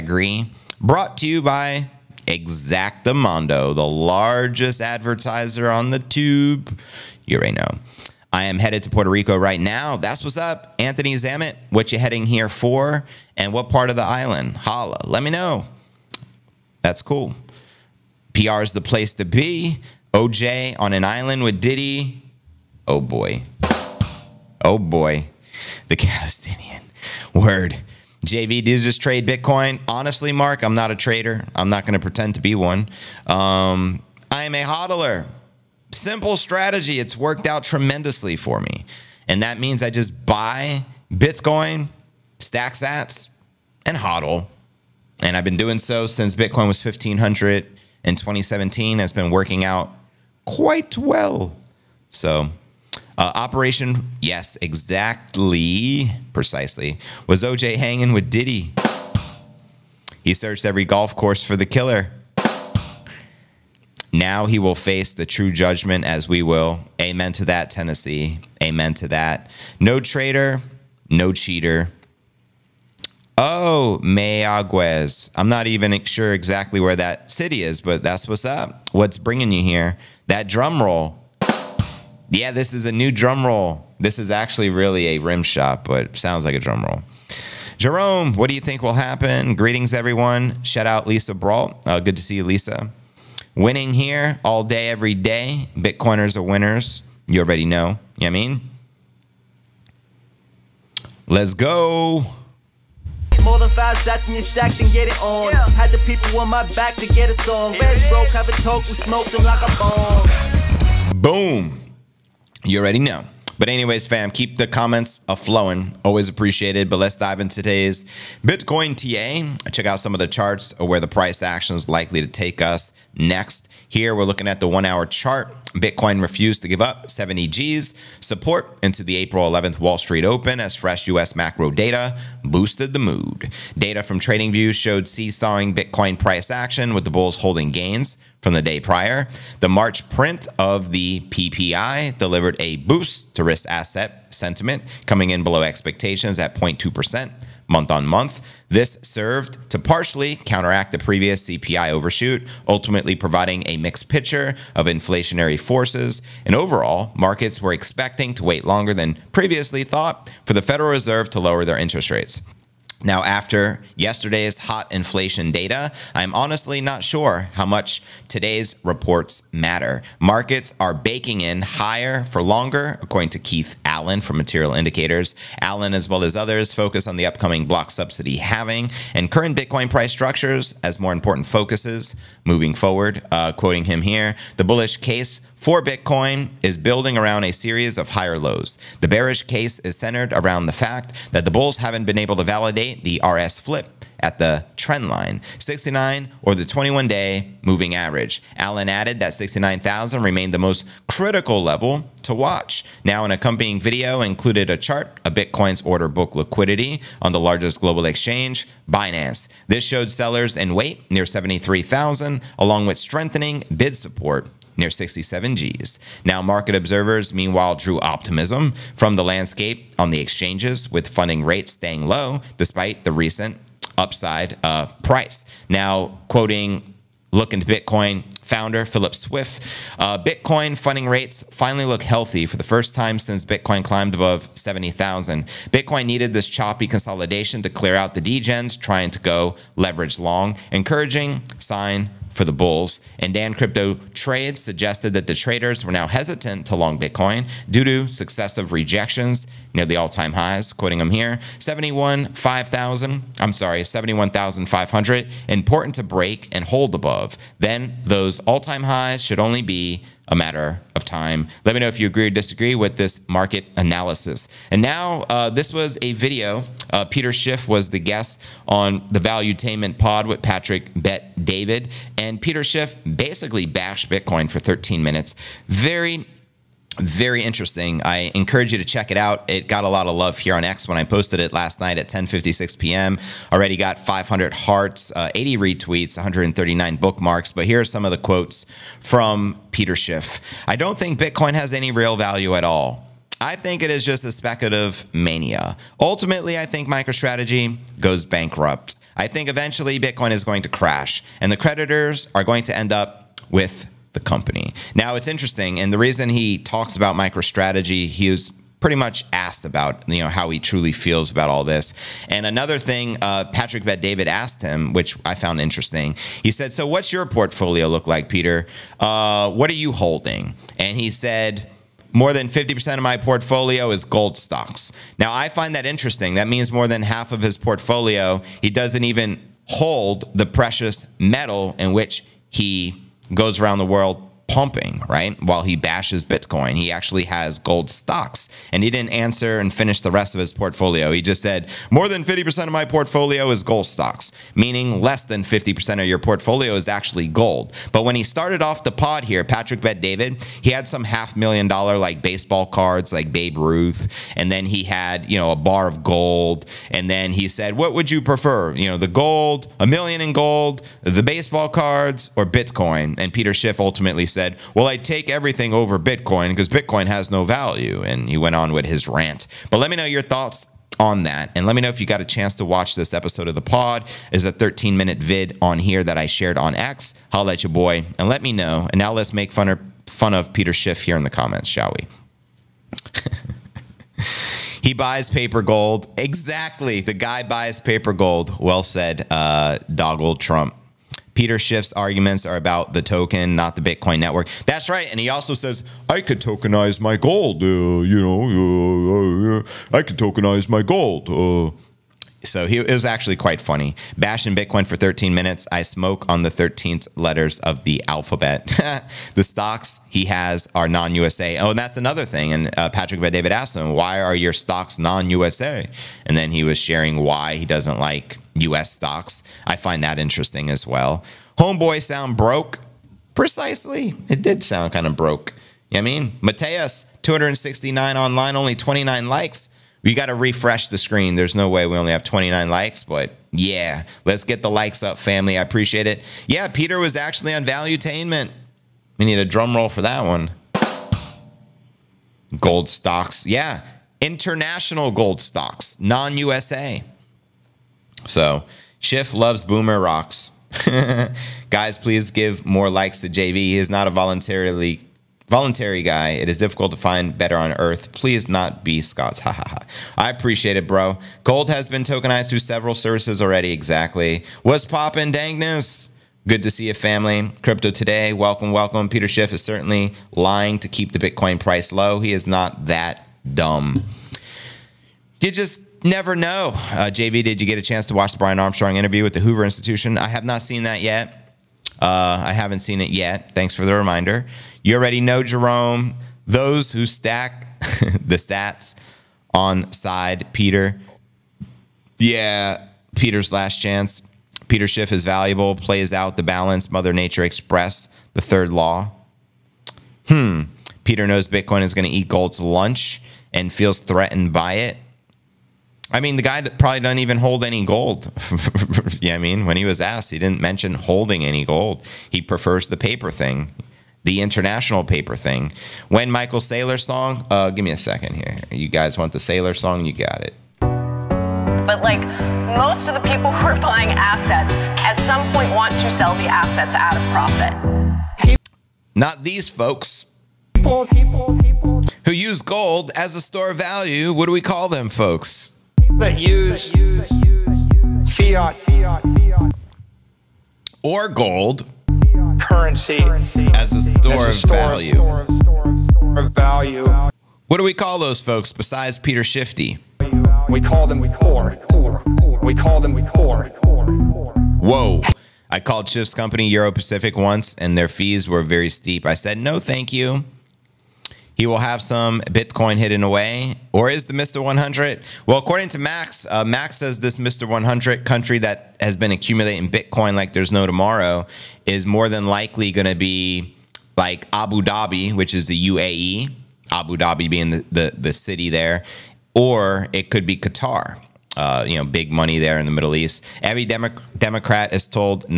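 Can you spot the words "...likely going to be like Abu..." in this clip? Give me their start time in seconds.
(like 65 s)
572 s.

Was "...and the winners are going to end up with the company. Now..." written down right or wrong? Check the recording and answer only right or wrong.
wrong.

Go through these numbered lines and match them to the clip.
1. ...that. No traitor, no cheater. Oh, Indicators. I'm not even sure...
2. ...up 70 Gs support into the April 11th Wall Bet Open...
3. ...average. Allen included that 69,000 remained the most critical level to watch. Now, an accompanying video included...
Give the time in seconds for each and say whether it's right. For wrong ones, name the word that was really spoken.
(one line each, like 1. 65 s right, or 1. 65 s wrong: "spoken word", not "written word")
1. 69 s wrong: "Mayaguez", not "Indicators"
2. 126 s wrong: "Street", not "Bet"
3. 197 s wrong: "added", not "included".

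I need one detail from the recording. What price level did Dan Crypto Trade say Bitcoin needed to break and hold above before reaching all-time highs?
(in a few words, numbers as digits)
71,500.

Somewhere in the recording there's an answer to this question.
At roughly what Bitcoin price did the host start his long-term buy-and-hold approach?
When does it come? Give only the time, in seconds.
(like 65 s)
46 s.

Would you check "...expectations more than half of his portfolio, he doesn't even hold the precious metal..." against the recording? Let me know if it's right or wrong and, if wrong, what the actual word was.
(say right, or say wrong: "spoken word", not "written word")
wrong: "means", not "expectations".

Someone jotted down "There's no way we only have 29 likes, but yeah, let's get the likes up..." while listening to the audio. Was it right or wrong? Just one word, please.
right.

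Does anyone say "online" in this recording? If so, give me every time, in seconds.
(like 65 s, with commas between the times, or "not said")
428 s.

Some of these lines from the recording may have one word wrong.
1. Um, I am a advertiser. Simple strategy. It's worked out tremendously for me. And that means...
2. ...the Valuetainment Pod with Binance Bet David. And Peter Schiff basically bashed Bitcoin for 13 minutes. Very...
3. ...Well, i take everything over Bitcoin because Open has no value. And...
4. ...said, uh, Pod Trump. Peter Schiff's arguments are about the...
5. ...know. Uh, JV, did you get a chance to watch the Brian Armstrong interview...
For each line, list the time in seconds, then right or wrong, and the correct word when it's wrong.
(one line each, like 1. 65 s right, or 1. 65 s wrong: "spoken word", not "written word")
1. 33 s wrong: "hodler", not "advertiser"
2. 269 s wrong: "Patrick", not "Binance"
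3. 364 s wrong: "Bitcoin", not "Open"
4. 388 s wrong: "Doggle", not "Pod"
5. 476 s right.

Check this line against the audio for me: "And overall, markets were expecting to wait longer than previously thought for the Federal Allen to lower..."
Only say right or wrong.
wrong.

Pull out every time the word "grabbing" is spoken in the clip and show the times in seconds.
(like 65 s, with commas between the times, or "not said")
not said.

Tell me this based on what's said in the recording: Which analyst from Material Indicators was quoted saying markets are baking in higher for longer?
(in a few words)
Keith Allen.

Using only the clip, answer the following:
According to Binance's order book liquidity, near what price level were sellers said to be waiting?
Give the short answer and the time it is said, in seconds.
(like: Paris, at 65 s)
73,000, at 211 s.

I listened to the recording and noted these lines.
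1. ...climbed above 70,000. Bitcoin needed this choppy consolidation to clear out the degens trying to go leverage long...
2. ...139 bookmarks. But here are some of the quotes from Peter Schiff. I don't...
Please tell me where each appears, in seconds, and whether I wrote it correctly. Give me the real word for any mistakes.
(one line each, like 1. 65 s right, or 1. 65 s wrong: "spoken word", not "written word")
1. 233 s right
2. 286 s right.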